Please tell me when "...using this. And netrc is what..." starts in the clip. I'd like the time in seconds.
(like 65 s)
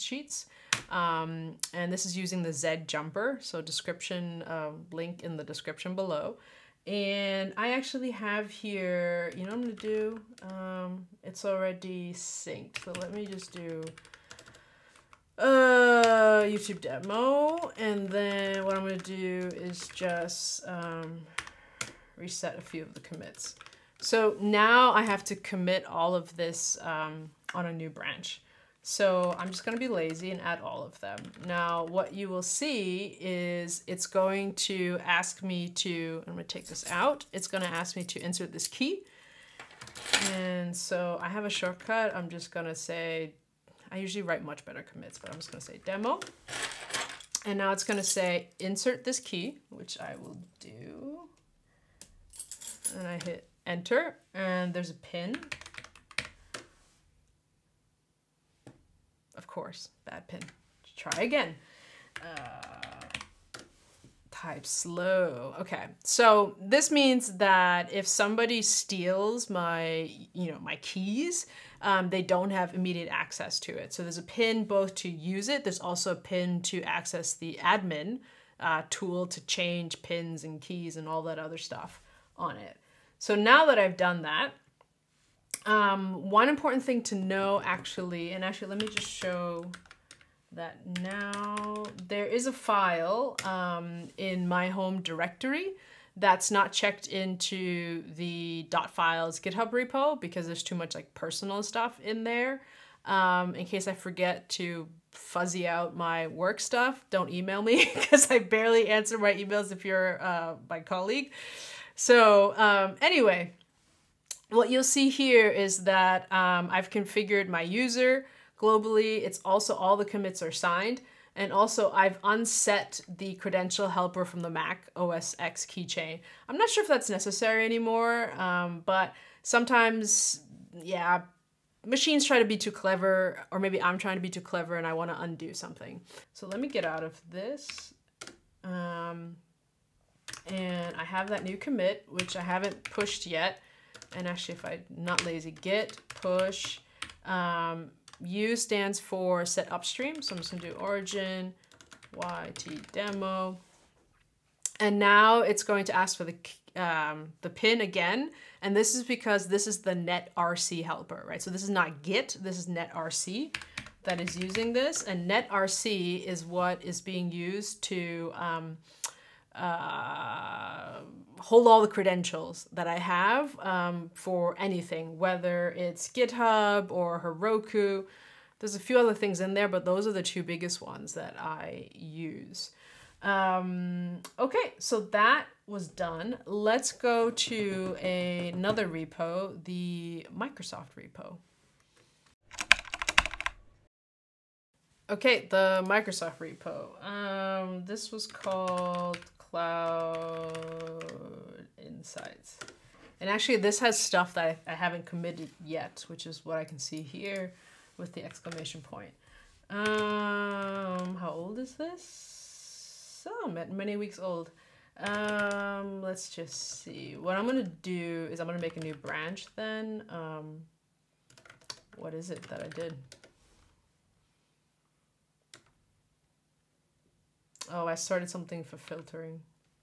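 164 s.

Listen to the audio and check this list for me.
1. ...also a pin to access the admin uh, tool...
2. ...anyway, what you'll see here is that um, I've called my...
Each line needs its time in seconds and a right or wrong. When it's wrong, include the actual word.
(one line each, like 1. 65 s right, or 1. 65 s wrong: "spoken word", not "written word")
1. 75 s right
2. 113 s wrong: "configured", not "called".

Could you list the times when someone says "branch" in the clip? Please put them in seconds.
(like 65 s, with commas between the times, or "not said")
27 s, 218 s.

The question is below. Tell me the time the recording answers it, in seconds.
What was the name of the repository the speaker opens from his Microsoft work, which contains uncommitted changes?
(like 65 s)
199 s.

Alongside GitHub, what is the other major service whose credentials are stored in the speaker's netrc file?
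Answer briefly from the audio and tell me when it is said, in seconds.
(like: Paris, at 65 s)
Heroku, at 177 s.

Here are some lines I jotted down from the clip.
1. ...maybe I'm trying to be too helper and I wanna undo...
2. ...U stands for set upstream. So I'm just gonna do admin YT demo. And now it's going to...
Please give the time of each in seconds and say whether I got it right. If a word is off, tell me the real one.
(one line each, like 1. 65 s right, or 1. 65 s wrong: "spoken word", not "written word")
1. 133 s wrong: "clever", not "helper"
2. 148 s wrong: "origin", not "admin".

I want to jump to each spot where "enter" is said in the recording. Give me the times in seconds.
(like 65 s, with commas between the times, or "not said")
53 s.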